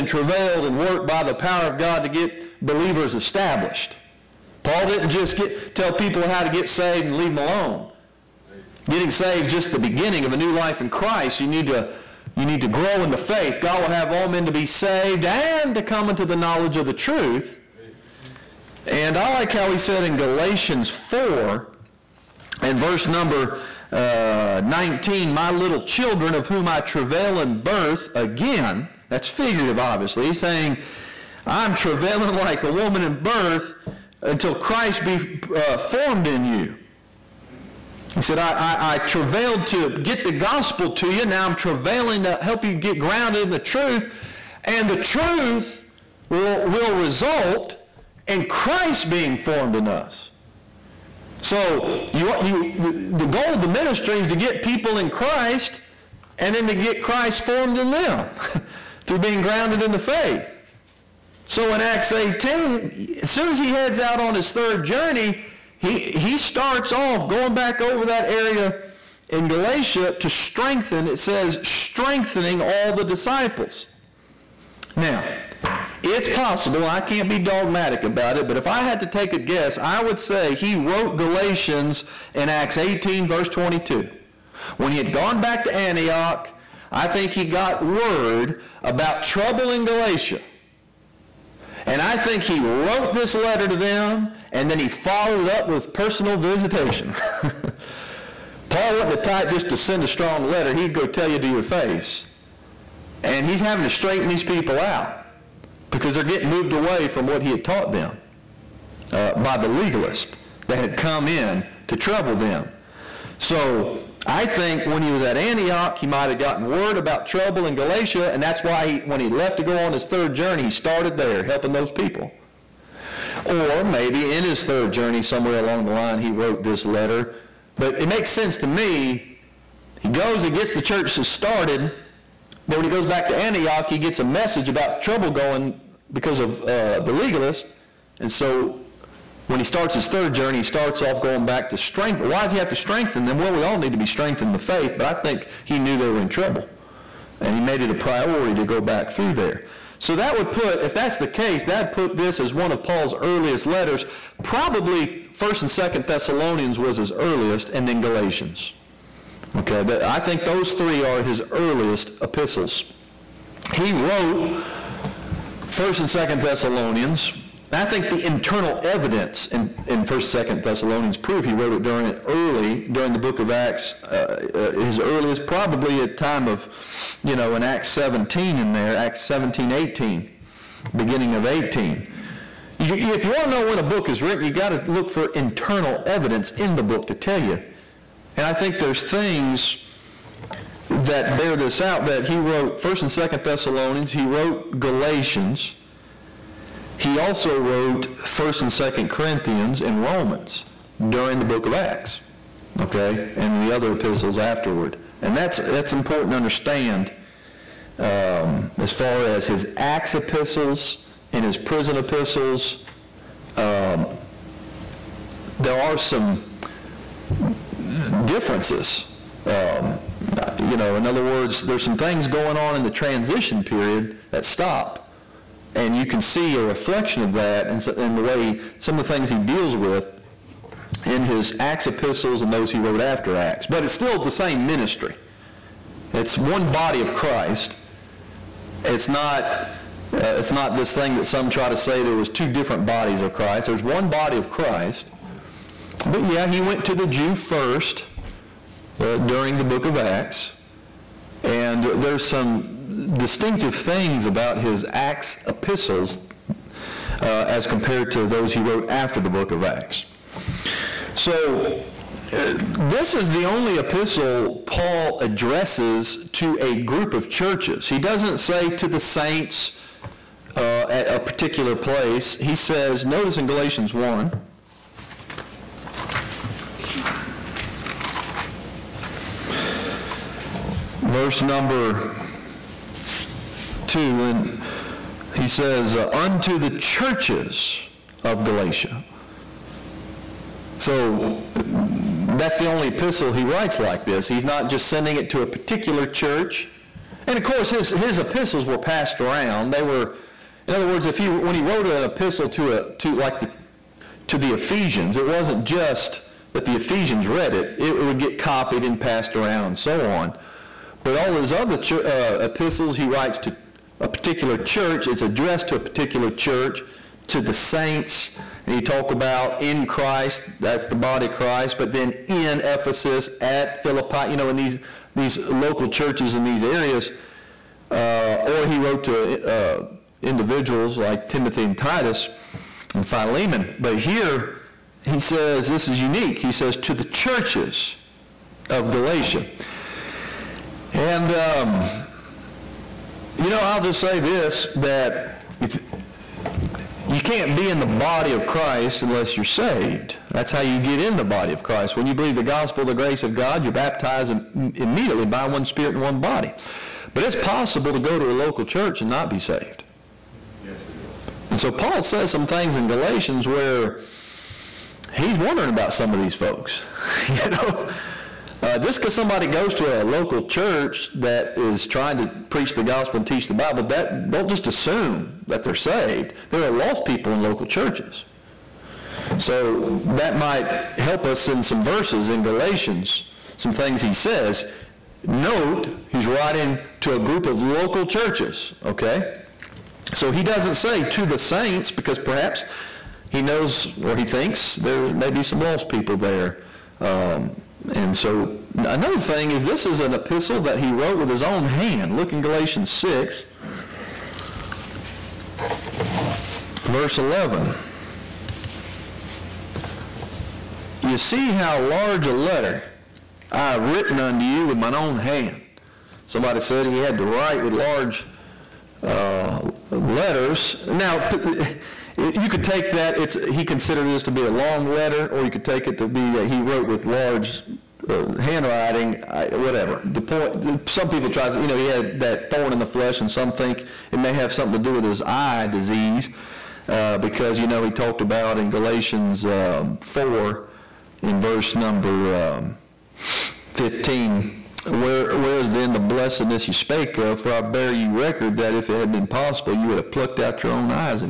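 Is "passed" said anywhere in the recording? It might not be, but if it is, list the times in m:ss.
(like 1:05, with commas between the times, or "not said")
4:58, 5:09.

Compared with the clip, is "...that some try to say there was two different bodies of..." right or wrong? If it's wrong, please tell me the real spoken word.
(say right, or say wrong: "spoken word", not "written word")
right.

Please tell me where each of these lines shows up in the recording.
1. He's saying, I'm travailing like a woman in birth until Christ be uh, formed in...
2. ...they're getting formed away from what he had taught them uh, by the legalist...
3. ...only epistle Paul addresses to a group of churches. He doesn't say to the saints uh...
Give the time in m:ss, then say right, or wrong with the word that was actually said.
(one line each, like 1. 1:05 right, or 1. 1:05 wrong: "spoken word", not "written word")
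1. 0:30 right
2. 1:46 wrong: "moved", not "formed"
3. 4:23 right.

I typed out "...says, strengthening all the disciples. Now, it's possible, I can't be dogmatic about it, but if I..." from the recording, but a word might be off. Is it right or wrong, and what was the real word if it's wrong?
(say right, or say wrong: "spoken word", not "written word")
right.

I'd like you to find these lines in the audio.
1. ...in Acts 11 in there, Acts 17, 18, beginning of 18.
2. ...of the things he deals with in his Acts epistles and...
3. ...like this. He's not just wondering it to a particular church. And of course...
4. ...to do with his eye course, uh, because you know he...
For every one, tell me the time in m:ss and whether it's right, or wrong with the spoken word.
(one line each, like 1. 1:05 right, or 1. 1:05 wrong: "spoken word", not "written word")
1. 2:57 wrong: "17", not "11"
2. 3:48 right
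3. 4:53 wrong: "sending", not "wondering"
4. 7:14 wrong: "disease", not "course".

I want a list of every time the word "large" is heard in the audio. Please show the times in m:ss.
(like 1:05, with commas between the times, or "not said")
6:51, 6:57, 7:07.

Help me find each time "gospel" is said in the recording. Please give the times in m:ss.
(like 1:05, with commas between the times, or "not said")
0:40, 5:52, 6:12.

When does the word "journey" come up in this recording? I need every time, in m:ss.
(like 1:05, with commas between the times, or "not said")
1:04, 2:00, 2:04, 2:20.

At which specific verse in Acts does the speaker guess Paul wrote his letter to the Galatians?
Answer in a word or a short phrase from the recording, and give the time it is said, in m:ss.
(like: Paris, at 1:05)
Acts 18:22, at 1:22.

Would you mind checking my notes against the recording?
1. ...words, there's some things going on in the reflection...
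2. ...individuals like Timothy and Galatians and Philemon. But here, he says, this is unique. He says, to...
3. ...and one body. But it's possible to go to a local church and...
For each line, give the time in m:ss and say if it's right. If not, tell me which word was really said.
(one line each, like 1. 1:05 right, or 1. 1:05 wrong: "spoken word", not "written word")
1. 3:41 wrong: "transition", not "reflection"
2. 5:30 wrong: "Titus", not "Galatians"
3. 5:55 right.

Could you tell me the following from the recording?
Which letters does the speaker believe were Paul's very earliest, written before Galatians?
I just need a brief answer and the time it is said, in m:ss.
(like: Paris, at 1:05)
1st and 2nd Thessalonians, at 2:35.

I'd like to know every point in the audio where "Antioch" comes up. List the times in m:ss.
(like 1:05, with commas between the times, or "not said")
1:25, 1:55, 2:13.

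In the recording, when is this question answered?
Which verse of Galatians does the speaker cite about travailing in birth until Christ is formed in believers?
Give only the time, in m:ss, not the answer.
0:20.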